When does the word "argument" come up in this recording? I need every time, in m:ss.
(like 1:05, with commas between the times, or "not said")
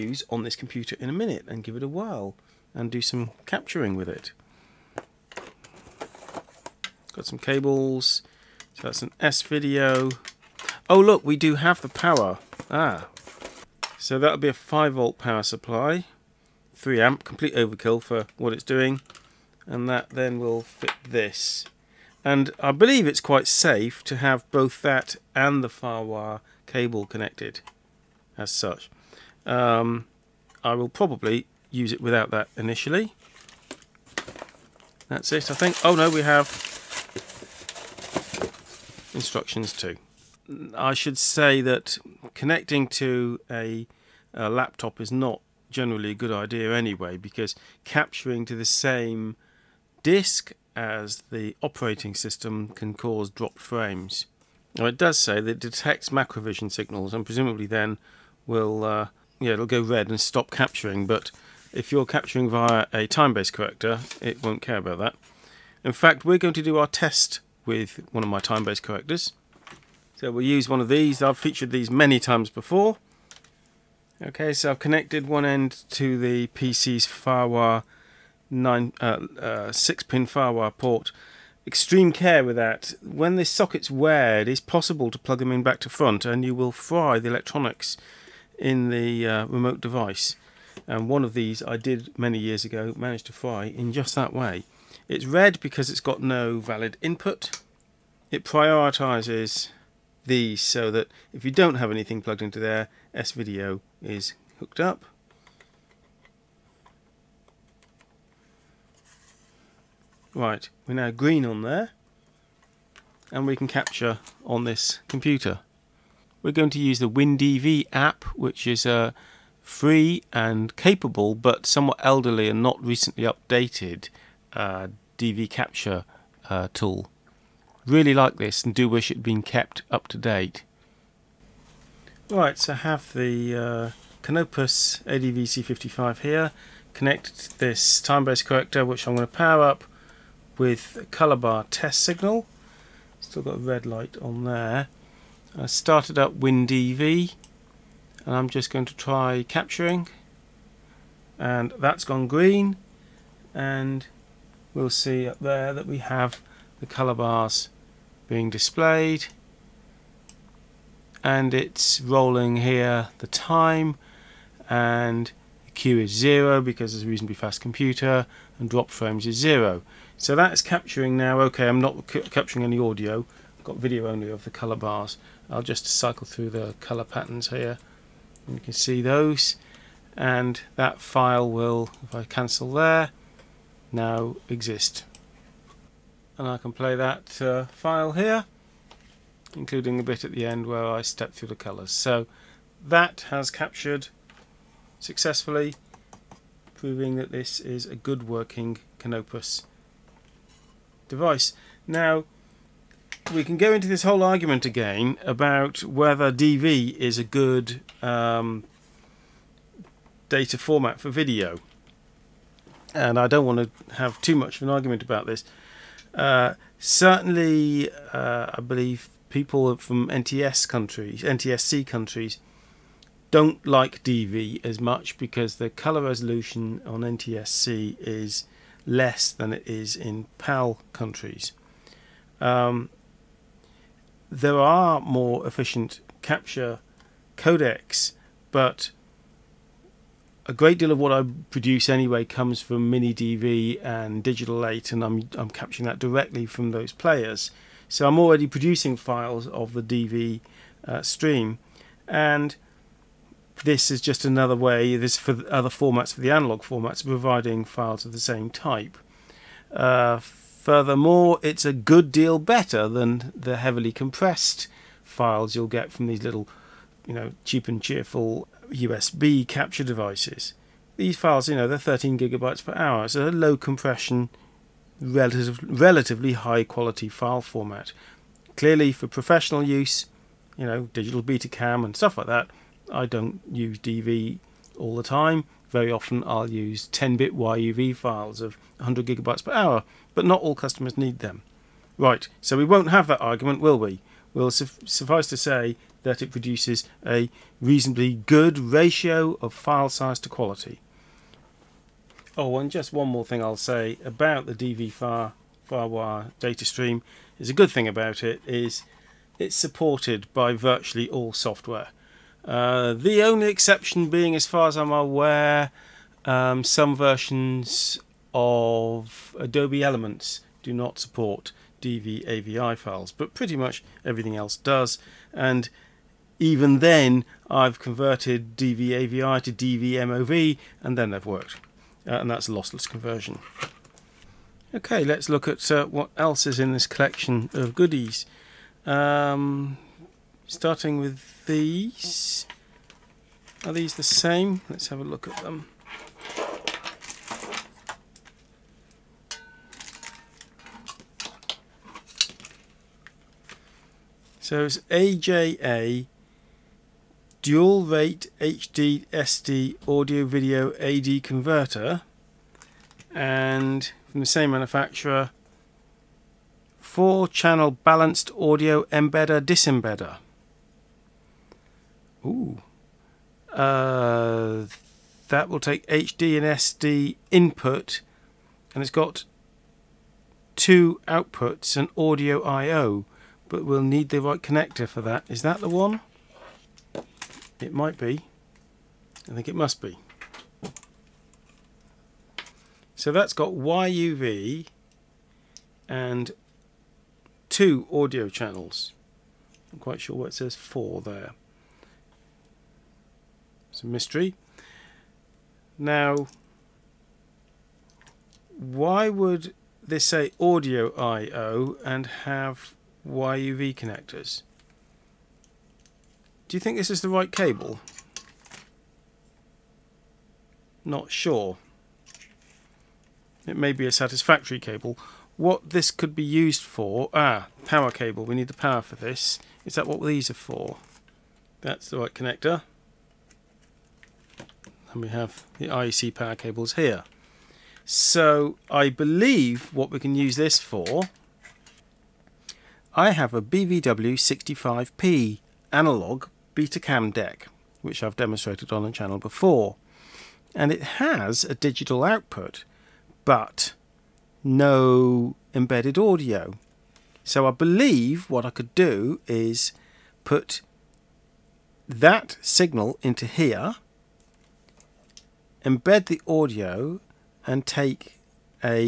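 3:24, 3:34, 4:53.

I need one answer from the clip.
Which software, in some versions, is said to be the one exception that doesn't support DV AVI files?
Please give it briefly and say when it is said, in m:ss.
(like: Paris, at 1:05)
Adobe Elements, at 5:19.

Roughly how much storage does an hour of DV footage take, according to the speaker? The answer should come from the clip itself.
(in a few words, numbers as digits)
13 gigabytes per hour.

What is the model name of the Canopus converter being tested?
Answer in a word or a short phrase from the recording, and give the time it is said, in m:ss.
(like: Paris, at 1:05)
ADVC55, at 2:14.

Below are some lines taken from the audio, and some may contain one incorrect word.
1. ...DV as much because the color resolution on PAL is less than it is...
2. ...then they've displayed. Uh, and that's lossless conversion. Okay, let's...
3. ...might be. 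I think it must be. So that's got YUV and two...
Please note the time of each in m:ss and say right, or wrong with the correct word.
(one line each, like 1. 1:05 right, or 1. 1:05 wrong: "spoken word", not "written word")
1. 3:44 wrong: "NTSC", not "PAL"
2. 5:30 wrong: "worked", not "displayed"
3. 6:27 right.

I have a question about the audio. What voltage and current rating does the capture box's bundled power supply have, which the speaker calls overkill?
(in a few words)
5 volt, 3 amp.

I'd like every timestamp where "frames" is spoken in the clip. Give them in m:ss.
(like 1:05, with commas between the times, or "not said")
0:53, 2:48.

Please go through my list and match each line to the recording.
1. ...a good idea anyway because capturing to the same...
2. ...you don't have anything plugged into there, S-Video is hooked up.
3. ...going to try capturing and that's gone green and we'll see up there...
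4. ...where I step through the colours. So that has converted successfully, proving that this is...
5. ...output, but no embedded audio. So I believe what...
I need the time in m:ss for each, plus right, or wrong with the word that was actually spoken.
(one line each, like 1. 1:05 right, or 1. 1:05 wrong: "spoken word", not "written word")
1. 0:46 right
2. 1:41 right
3. 2:28 right
4. 3:10 wrong: "captured", not "converted"
5. 7:32 right.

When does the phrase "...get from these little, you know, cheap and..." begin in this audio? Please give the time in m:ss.
4:25.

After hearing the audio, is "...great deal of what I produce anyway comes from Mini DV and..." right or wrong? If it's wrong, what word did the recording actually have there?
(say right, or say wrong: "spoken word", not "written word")
right.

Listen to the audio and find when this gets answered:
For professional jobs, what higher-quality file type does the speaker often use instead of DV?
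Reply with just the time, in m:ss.
4:46.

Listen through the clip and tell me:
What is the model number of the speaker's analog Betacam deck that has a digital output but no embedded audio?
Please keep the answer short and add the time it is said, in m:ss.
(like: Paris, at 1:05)
BVW65P, at 7:23.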